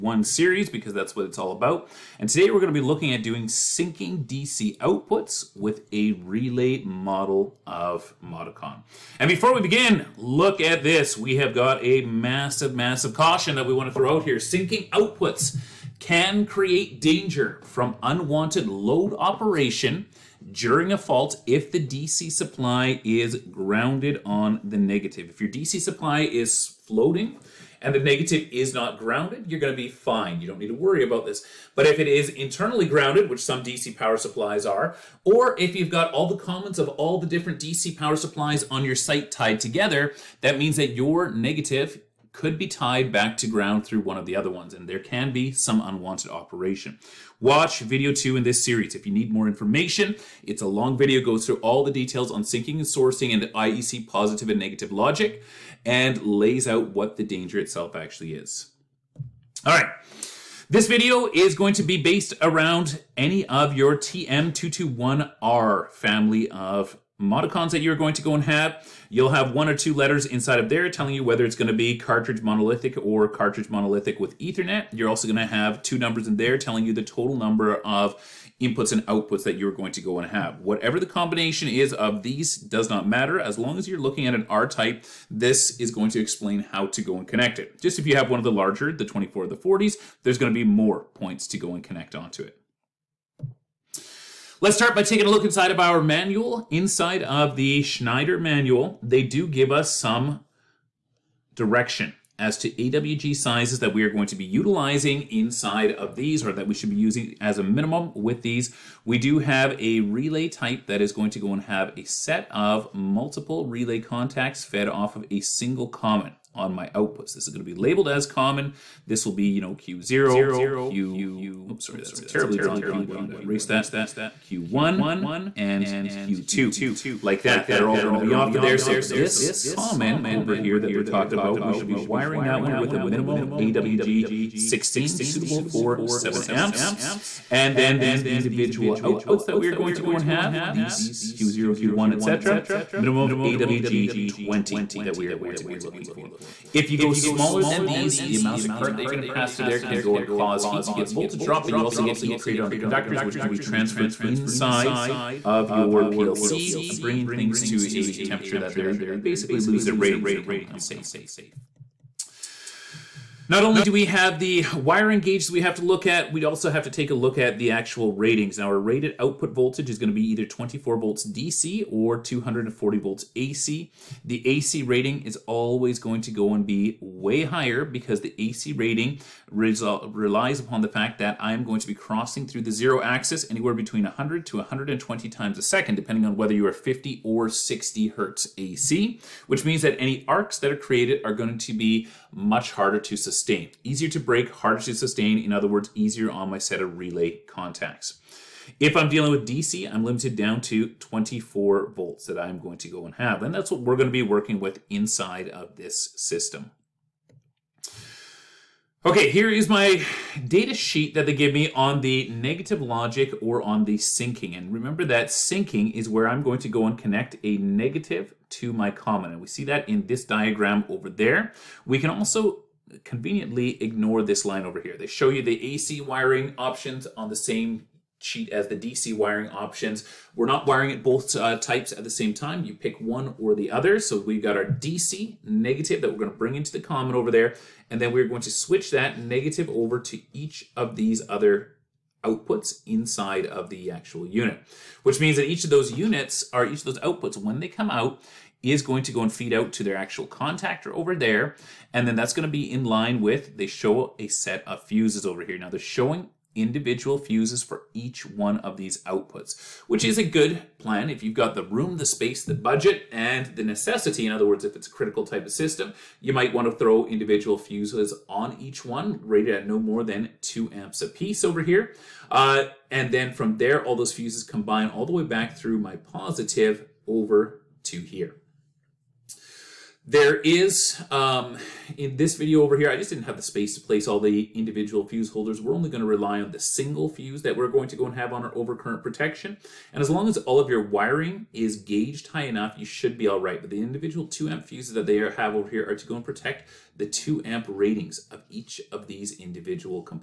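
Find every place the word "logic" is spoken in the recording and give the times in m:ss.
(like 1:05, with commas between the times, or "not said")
0:54, 3:32.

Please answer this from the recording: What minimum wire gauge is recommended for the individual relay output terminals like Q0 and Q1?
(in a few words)
AWG 20.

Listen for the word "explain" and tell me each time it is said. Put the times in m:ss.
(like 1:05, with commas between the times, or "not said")
1:26.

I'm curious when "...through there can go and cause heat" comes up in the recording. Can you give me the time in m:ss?
2:29.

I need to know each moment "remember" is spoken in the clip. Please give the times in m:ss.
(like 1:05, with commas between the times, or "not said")
3:34.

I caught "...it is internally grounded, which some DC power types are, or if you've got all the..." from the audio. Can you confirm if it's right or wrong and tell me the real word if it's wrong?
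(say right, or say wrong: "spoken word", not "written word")
wrong: "supplies", not "types".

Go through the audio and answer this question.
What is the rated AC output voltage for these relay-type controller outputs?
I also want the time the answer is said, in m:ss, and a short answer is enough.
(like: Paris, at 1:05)
240 volts, at 2:52.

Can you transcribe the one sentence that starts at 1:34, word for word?
Let's start by taking a look inside of our manual.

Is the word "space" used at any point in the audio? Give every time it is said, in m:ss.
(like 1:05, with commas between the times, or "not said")
4:22, 4:43.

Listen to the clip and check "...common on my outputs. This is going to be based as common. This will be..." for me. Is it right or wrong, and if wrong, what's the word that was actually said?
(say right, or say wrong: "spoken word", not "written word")
wrong: "labeled", not "based".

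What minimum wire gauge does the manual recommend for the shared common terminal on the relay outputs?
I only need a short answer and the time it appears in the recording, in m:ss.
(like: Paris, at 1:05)
AWG 16, at 2:13.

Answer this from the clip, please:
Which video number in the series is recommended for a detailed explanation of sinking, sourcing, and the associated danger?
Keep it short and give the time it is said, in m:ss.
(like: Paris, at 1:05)
2, at 0:47.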